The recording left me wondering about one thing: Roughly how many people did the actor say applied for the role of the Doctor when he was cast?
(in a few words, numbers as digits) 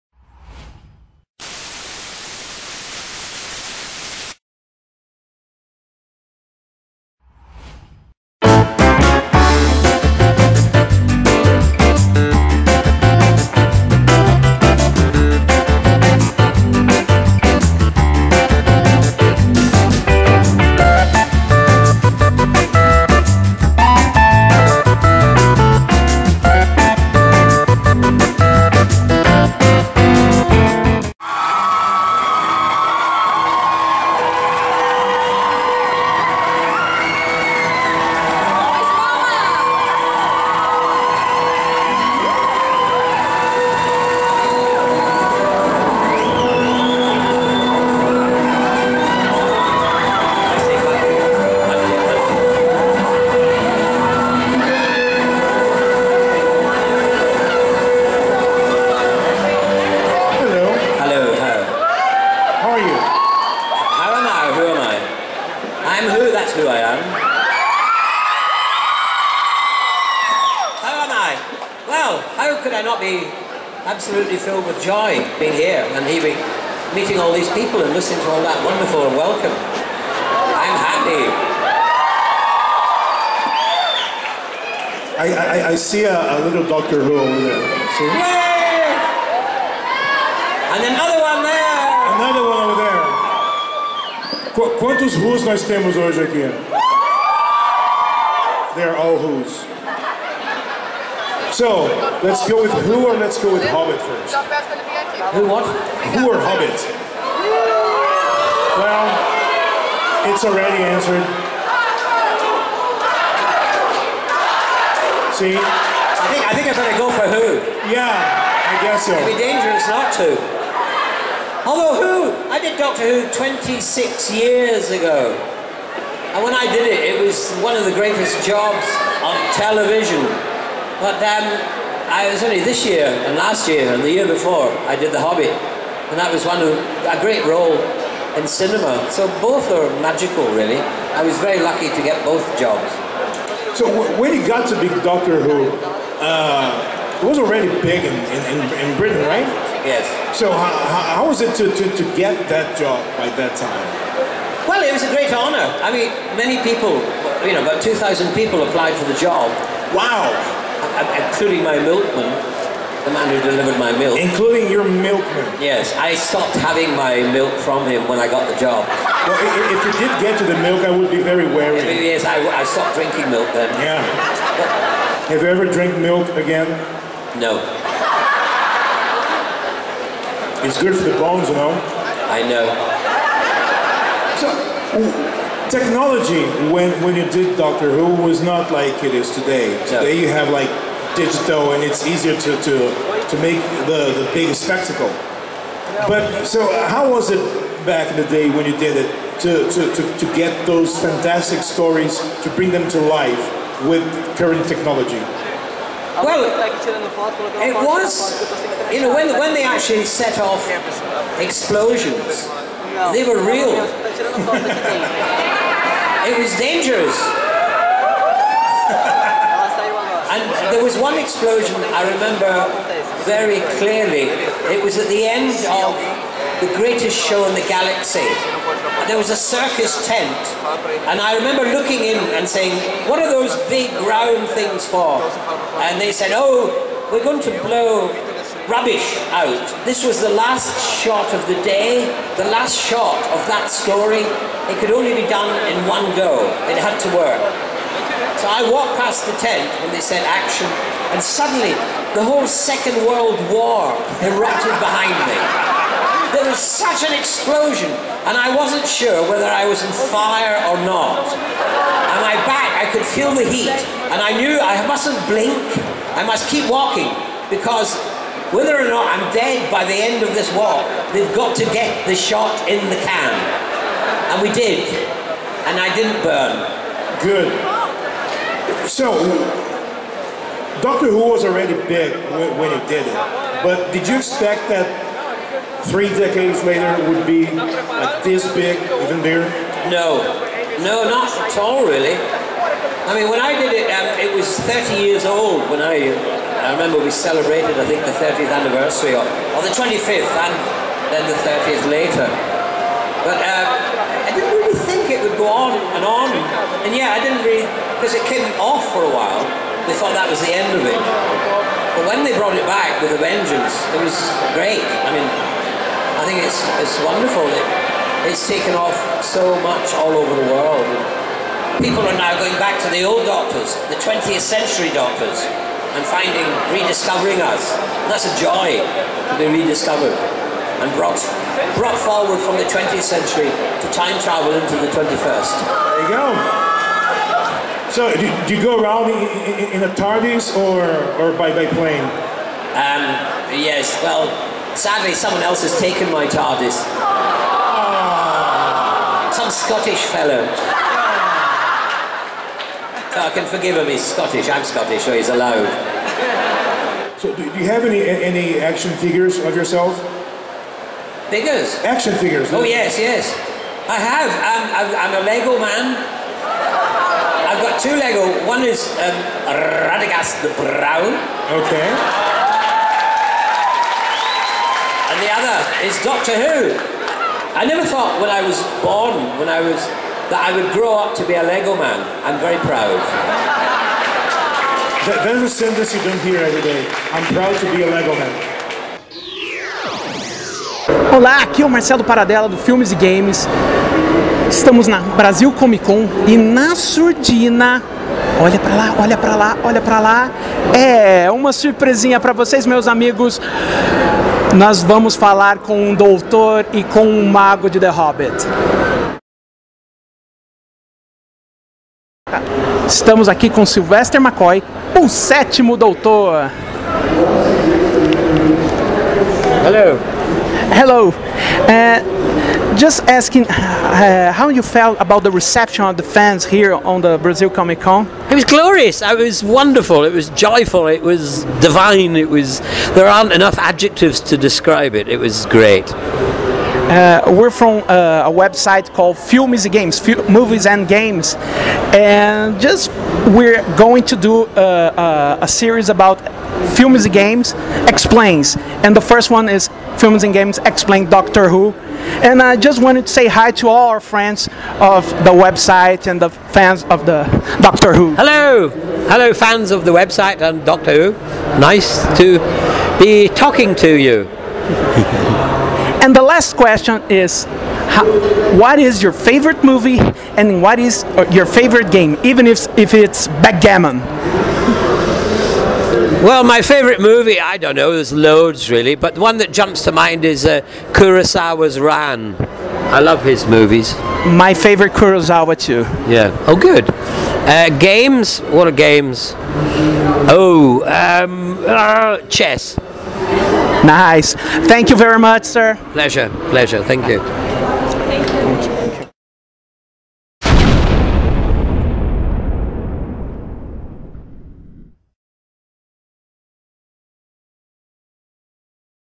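2,000.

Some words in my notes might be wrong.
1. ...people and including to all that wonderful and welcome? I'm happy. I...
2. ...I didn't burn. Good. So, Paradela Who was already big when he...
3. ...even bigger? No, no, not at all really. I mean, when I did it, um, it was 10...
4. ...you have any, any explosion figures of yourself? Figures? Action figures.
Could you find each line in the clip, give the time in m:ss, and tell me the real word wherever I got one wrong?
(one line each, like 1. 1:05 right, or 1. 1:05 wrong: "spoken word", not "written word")
1. 1:17 wrong: "listening", not "including"
2. 4:35 wrong: "Doctor", not "Paradela"
3. 4:48 wrong: "30", not "10"
4. 5:57 wrong: "action", not "explosion".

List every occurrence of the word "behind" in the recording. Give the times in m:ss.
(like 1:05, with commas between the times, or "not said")
4:14.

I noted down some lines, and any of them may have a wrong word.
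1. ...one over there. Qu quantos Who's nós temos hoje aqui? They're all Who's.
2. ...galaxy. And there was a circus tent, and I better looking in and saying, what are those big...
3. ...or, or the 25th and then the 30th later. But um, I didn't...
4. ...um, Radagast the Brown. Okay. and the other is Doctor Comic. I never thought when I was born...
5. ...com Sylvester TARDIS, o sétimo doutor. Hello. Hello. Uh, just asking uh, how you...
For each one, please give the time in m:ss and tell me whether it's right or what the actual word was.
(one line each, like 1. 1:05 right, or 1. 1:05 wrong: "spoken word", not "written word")
1. 1:32 right
2. 3:47 wrong: "remember", not "better"
3. 4:59 right
4. 6:08 wrong: "Who", not "Comic"
5. 6:53 wrong: "McCoy", not "TARDIS".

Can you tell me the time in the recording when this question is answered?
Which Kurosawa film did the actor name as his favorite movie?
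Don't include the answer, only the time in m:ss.
8:01.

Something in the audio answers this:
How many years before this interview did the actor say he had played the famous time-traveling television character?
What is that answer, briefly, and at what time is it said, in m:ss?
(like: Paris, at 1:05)
26, at 2:03.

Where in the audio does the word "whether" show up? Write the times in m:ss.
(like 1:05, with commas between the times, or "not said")
4:19, 4:28.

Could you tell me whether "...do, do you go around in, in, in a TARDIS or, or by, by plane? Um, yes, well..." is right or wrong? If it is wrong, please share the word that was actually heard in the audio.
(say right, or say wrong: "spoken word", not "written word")
right.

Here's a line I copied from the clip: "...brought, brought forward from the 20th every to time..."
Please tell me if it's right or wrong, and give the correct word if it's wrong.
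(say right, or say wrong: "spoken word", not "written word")
wrong: "century", not "every".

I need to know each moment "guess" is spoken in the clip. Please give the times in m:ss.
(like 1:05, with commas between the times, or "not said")
1:58.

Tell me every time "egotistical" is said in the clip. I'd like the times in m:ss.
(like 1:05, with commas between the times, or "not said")
not said.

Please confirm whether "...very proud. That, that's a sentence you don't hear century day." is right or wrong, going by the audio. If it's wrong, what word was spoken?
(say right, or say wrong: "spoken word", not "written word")
wrong: "every", not "century".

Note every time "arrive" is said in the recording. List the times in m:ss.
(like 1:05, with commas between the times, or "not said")
not said.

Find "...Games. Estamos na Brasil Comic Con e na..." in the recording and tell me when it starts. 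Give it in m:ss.
6:32.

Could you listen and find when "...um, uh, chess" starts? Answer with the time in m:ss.
8:10.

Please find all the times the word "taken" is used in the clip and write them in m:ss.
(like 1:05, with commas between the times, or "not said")
5:18, 5:45.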